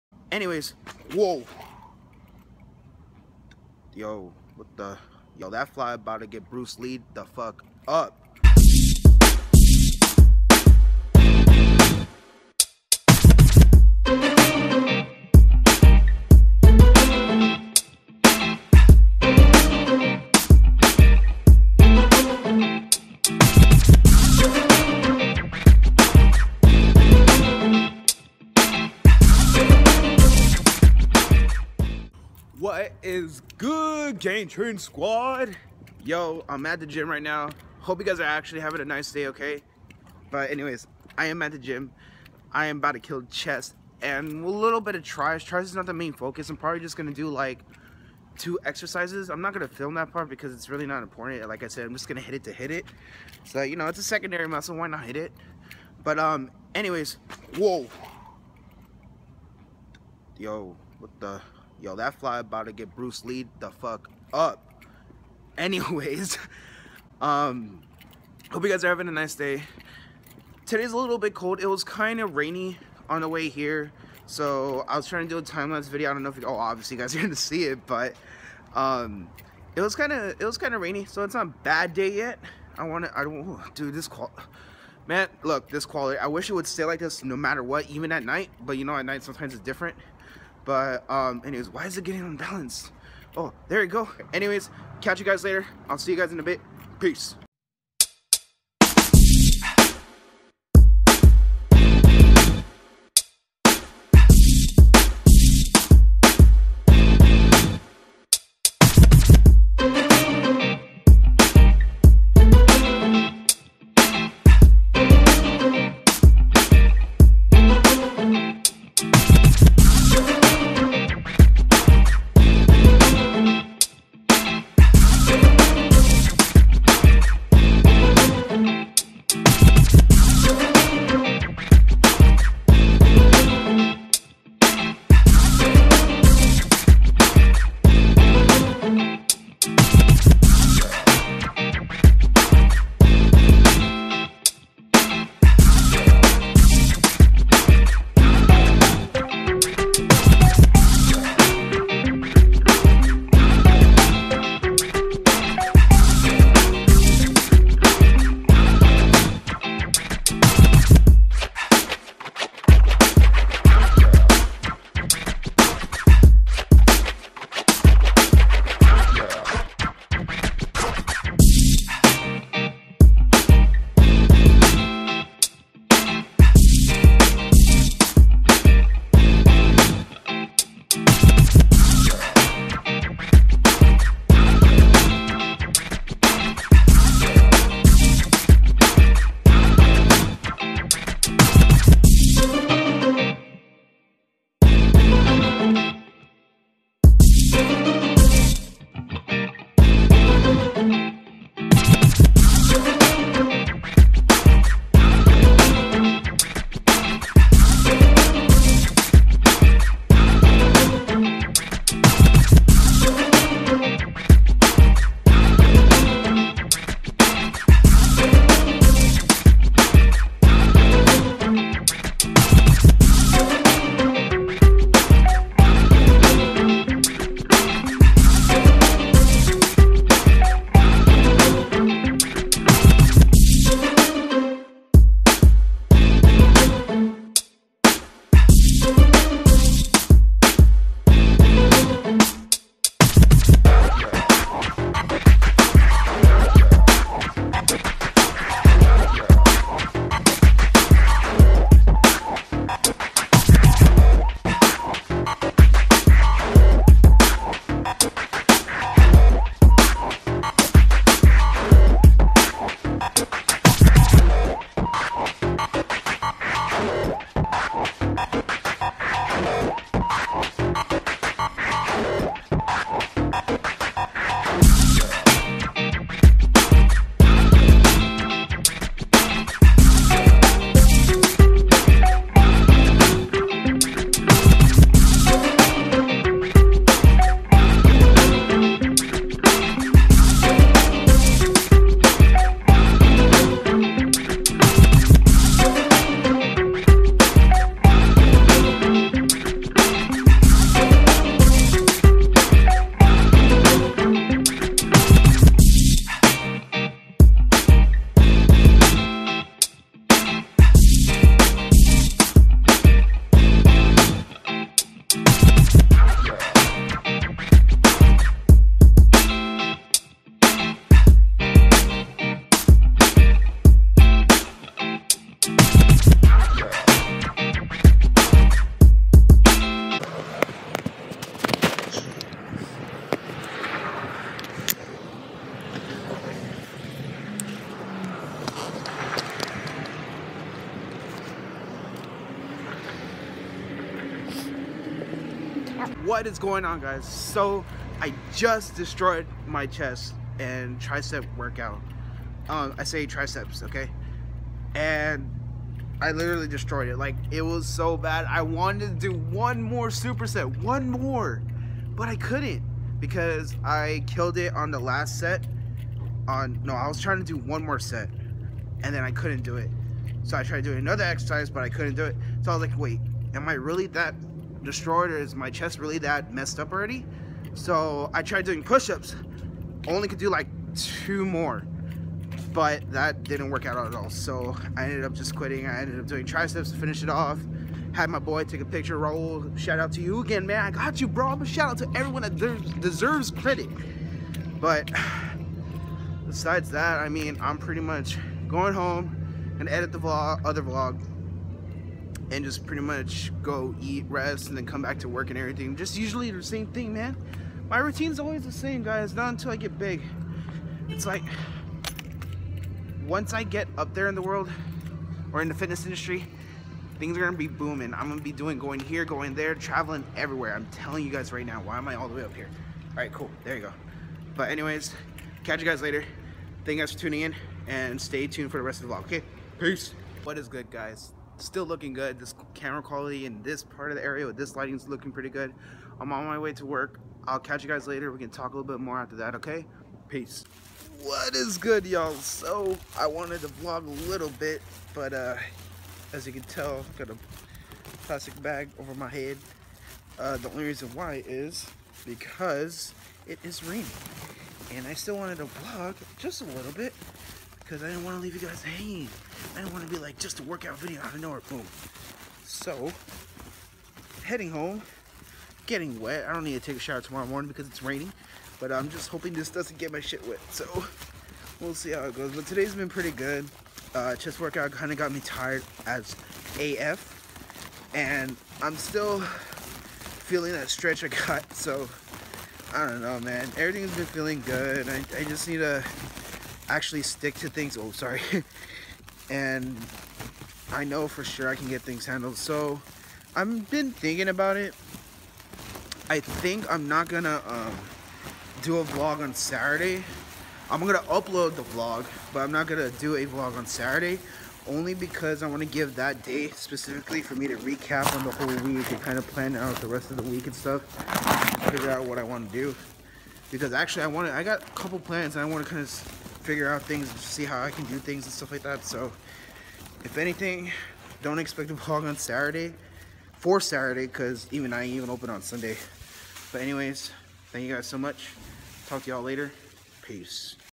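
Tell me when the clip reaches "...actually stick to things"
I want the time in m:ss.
8:06.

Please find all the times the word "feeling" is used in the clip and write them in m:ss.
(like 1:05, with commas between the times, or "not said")
7:59, 8:04.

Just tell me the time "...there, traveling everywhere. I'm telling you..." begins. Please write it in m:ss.
6:59.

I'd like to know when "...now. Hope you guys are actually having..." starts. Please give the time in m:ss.
0:37.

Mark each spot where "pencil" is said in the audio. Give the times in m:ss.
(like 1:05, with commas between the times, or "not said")
not said.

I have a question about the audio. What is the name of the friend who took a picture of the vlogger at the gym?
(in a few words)
Raul.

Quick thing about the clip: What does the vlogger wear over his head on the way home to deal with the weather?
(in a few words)
A plastic bag.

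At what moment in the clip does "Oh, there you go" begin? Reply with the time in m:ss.
1:33.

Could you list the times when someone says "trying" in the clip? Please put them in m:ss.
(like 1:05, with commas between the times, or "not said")
1:15, 6:06.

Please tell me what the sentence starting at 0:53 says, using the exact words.
So you know, it's a secondary muscle.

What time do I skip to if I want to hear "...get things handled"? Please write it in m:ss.
8:11.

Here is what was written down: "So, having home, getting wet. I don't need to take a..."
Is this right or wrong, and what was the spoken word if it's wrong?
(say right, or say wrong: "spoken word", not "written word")
wrong: "heading", not "having".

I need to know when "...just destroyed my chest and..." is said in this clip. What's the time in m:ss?
5:48.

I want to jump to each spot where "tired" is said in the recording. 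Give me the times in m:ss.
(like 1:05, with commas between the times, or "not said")
7:55.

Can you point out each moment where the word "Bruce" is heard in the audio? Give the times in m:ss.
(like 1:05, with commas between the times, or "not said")
0:06, 1:02.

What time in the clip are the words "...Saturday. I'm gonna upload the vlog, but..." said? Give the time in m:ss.
8:19.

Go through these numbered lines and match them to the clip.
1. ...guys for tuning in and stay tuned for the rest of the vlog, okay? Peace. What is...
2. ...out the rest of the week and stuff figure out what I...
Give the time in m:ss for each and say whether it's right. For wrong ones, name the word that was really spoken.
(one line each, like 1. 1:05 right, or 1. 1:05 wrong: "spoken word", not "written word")
1. 7:06 right
2. 8:29 right.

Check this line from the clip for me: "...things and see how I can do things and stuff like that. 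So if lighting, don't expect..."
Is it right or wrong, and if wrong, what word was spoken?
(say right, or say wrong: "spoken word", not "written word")
wrong: "anything", not "lighting".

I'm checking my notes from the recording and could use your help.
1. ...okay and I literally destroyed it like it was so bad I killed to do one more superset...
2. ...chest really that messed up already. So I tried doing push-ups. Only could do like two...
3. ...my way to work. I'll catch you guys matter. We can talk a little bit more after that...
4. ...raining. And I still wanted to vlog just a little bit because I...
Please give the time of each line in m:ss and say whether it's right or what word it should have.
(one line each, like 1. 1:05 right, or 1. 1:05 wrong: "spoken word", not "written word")
1. 5:53 wrong: "wanted", not "killed"
2. 6:15 right
3. 7:16 wrong: "later", not "matter"
4. 7:33 right.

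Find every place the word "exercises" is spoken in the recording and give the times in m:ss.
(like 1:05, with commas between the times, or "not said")
0:48, 6:11.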